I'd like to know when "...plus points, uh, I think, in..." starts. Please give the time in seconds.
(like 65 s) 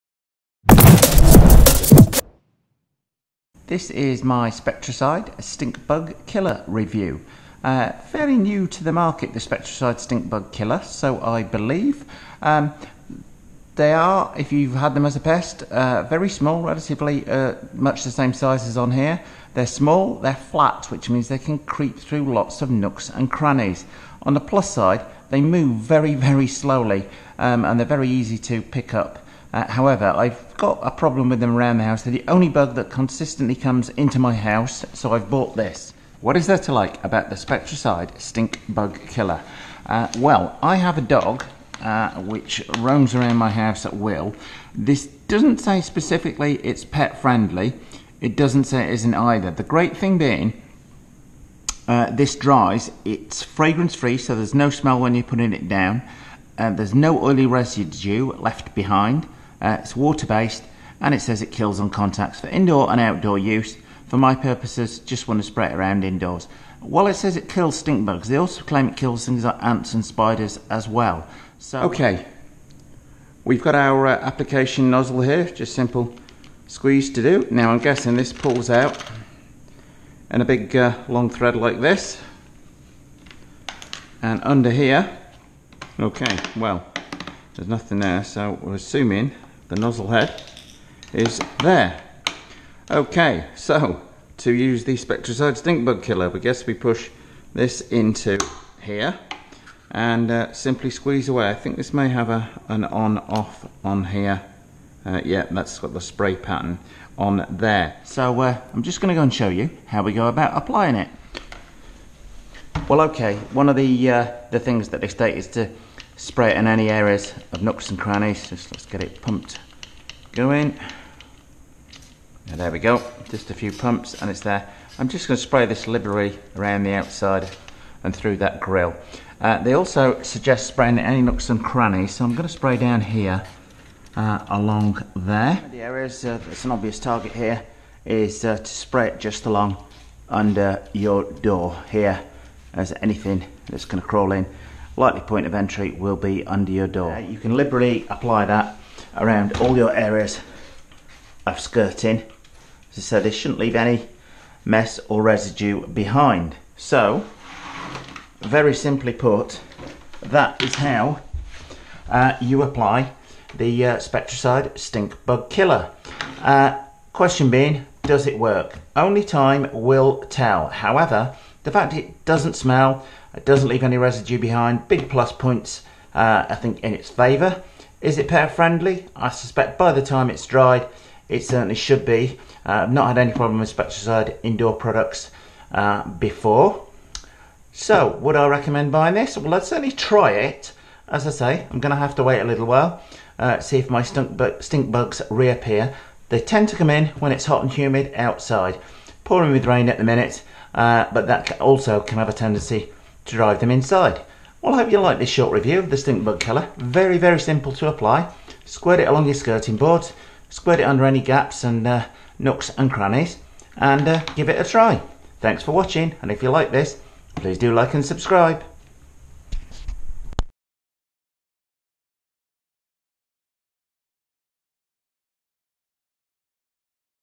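175 s.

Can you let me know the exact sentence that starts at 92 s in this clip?
Okay, so to use the Spectracide stink bug killer, we guess we push this into here and uh, simply squeeze away.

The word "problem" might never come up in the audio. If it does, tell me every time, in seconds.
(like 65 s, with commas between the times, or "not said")
30 s, 183 s.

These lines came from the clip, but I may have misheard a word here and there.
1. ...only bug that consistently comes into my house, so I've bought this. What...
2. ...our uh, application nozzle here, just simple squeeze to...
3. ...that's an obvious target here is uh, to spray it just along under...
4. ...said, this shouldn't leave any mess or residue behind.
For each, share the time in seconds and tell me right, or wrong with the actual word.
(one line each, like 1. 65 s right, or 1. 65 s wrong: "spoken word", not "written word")
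1. 32 s right
2. 73 s right
3. 136 s right
4. 153 s right.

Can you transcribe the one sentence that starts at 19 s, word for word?
They're small, they're flat, which means they can creep through lots of nooks and crannies.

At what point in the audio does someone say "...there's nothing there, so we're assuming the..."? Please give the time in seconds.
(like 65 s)
87 s.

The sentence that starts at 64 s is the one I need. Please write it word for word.
For my purposes, just want to spray it around indoors.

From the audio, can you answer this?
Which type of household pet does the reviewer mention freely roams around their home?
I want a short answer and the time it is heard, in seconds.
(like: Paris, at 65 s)
Dog, at 41 s.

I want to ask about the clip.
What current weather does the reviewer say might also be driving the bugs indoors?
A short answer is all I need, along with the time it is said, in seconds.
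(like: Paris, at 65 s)
Pouring with rain, at 199 s.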